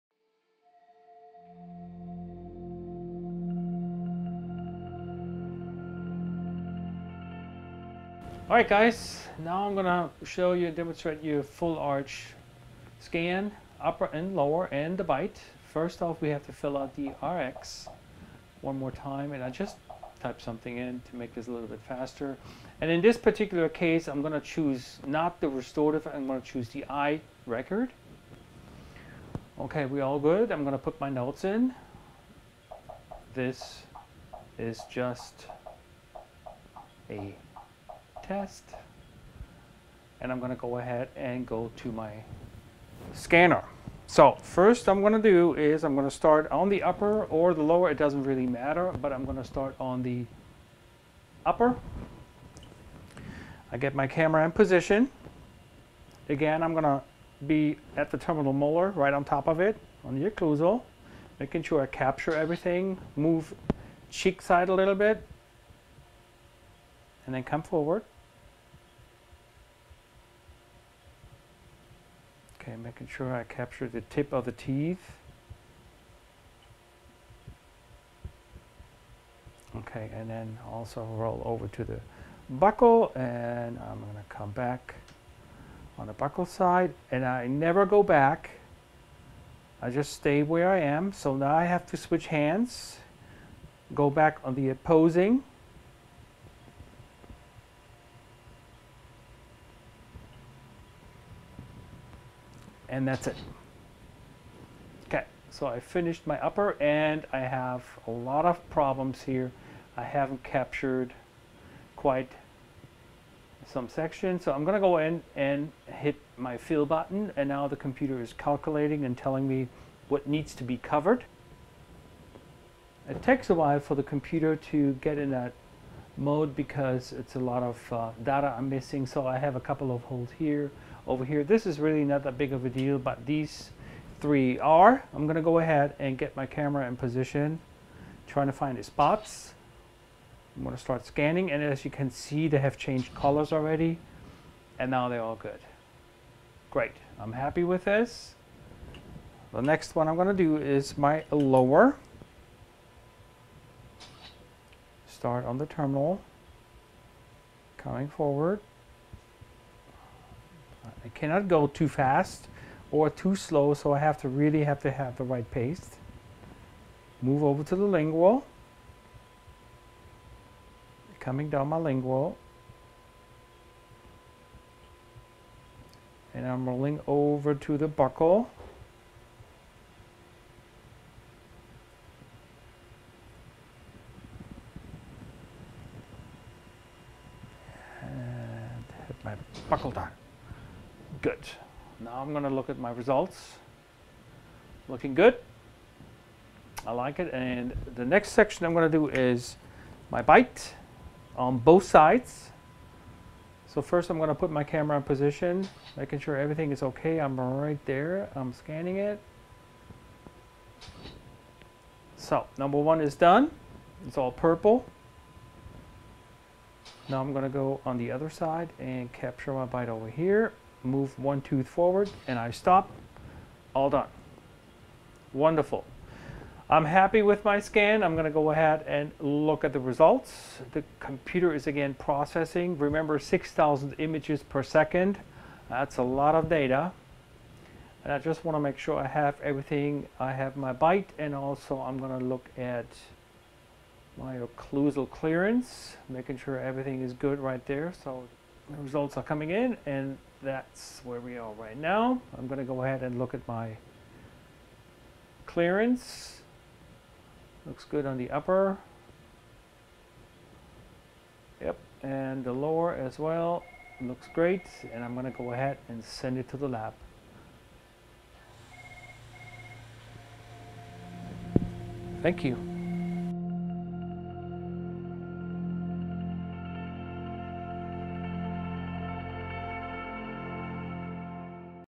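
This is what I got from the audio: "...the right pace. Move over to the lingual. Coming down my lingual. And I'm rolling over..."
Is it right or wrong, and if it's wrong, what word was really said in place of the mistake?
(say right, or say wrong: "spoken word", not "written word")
right.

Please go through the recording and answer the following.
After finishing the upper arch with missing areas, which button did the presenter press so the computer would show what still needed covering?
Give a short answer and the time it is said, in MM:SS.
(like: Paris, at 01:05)
fill button, at 01:56.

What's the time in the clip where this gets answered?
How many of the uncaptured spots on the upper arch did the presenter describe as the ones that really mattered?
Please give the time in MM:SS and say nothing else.
02:14.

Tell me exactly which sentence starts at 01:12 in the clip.
Okay, making sure I capture the tip of the teeth.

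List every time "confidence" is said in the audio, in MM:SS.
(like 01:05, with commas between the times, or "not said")
not said.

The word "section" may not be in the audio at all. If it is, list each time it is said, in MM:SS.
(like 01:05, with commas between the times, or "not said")
01:53, 03:18.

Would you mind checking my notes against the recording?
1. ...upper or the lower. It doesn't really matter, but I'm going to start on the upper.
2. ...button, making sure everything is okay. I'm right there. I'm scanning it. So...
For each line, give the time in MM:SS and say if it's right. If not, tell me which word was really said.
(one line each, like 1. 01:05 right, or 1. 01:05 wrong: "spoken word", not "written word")
1. 00:46 right
2. 03:25 wrong: "position", not "button".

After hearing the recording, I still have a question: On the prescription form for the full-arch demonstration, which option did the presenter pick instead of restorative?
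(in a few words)
I record.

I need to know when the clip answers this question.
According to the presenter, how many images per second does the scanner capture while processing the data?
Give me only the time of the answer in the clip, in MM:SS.
03:53.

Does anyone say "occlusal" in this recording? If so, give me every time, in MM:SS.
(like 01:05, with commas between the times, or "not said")
01:00, 04:04.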